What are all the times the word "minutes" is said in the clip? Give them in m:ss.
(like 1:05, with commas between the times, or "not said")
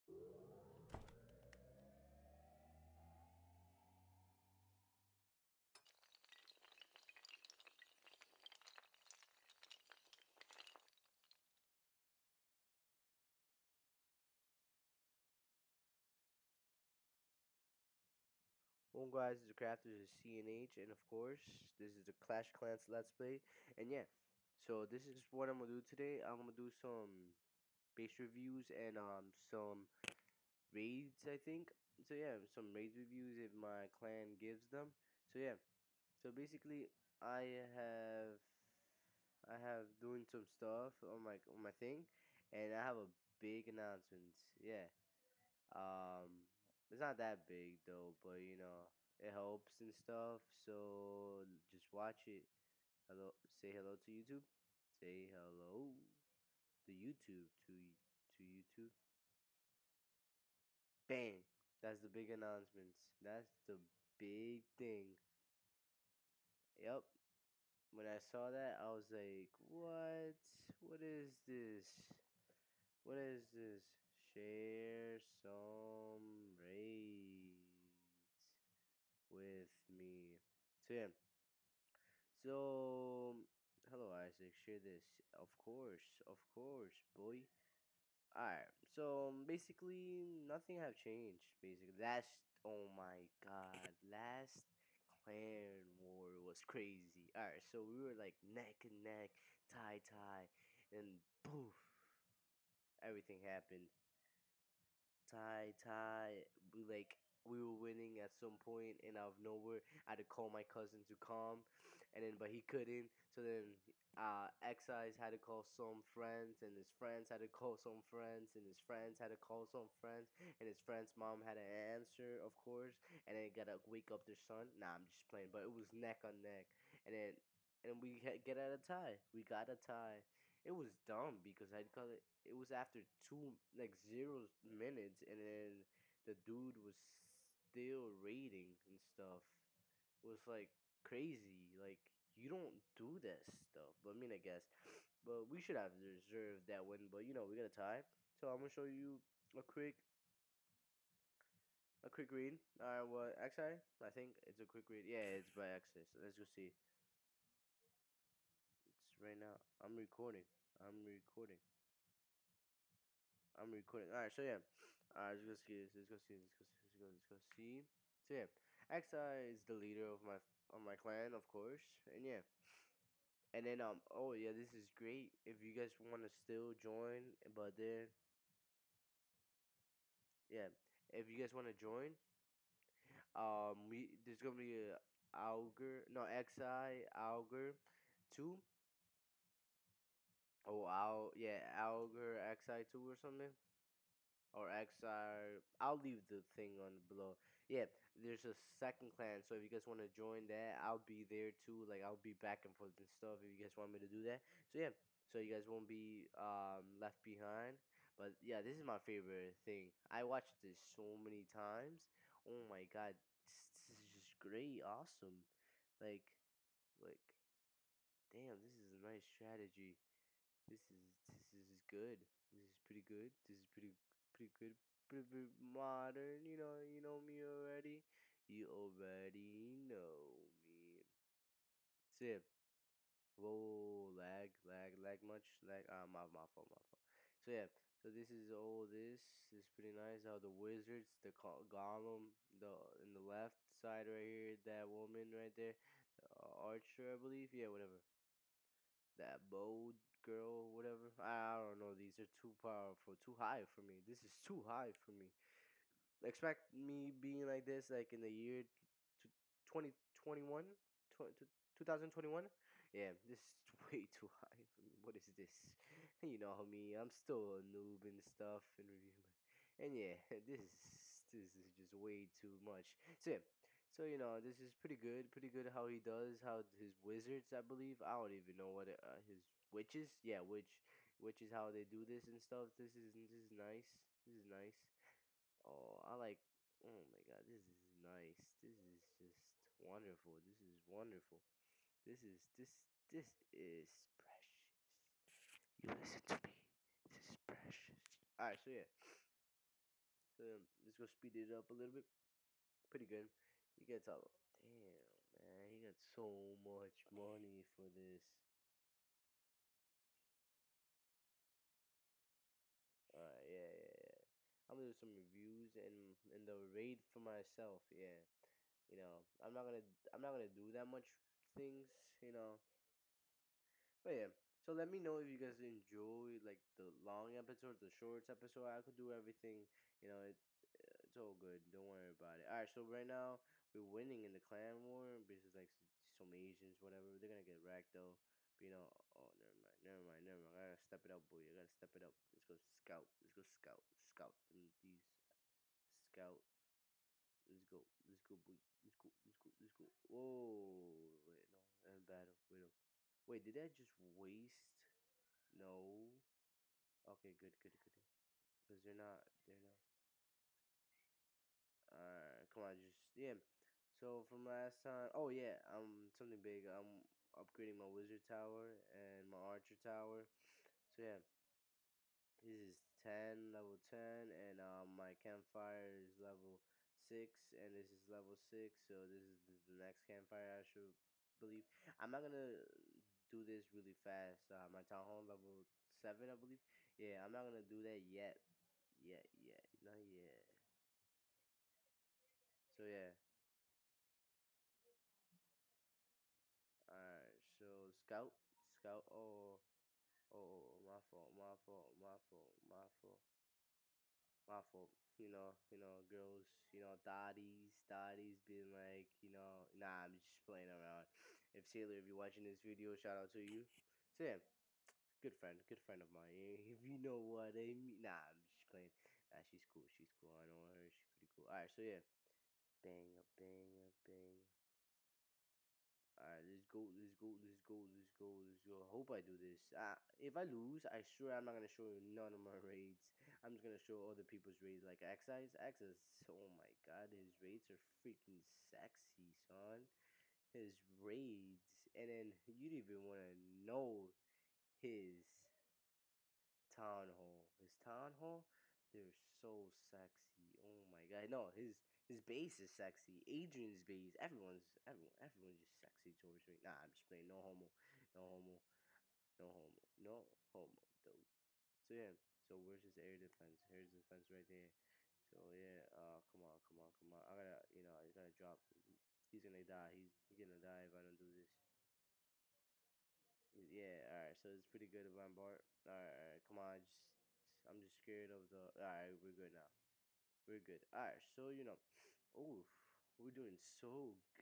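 2:14.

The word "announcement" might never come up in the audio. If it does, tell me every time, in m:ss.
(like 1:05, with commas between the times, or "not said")
0:43, 1:02.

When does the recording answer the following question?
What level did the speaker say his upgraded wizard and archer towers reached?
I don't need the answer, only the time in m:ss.
6:13.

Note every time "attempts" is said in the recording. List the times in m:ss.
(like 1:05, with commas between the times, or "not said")
not said.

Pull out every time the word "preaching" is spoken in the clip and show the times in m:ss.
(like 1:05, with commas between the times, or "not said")
not said.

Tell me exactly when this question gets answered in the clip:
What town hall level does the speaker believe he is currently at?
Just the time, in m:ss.
6:24.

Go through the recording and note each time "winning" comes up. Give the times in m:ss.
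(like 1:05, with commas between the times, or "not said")
1:47, 5:33.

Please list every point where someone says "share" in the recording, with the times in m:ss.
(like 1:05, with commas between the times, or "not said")
1:14, 1:24.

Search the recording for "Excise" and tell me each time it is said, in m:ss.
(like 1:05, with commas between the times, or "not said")
1:54.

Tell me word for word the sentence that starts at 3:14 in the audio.
Or XR, I'll leave the thing on below.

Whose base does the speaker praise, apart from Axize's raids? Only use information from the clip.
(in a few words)
Adrian.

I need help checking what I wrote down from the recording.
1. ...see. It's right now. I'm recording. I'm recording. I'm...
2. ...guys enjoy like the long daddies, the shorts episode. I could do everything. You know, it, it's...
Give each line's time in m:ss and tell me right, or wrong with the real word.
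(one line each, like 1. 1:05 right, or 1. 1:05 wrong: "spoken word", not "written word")
1. 2:36 right
2. 5:25 wrong: "episodes", not "daddies".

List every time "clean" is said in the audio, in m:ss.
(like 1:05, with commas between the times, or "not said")
not said.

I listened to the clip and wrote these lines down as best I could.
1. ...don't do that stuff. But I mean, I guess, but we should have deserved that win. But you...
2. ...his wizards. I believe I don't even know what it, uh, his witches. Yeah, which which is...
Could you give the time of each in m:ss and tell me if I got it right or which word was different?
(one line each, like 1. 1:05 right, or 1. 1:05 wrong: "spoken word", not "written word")
1. 2:22 right
2. 4:36 right.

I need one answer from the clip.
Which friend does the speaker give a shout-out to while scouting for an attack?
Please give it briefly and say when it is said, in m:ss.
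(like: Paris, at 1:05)
Taylor, at 6:51.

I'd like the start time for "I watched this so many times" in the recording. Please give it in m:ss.
3:30.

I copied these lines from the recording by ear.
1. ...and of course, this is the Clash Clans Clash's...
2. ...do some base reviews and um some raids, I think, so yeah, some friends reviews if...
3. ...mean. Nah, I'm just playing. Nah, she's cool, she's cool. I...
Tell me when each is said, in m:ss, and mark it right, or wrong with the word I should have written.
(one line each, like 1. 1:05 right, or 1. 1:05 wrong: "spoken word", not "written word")
1. 0:20 wrong: "Let", not "Clash"
2. 0:26 wrong: "raids", not "friends"
3. 6:57 right.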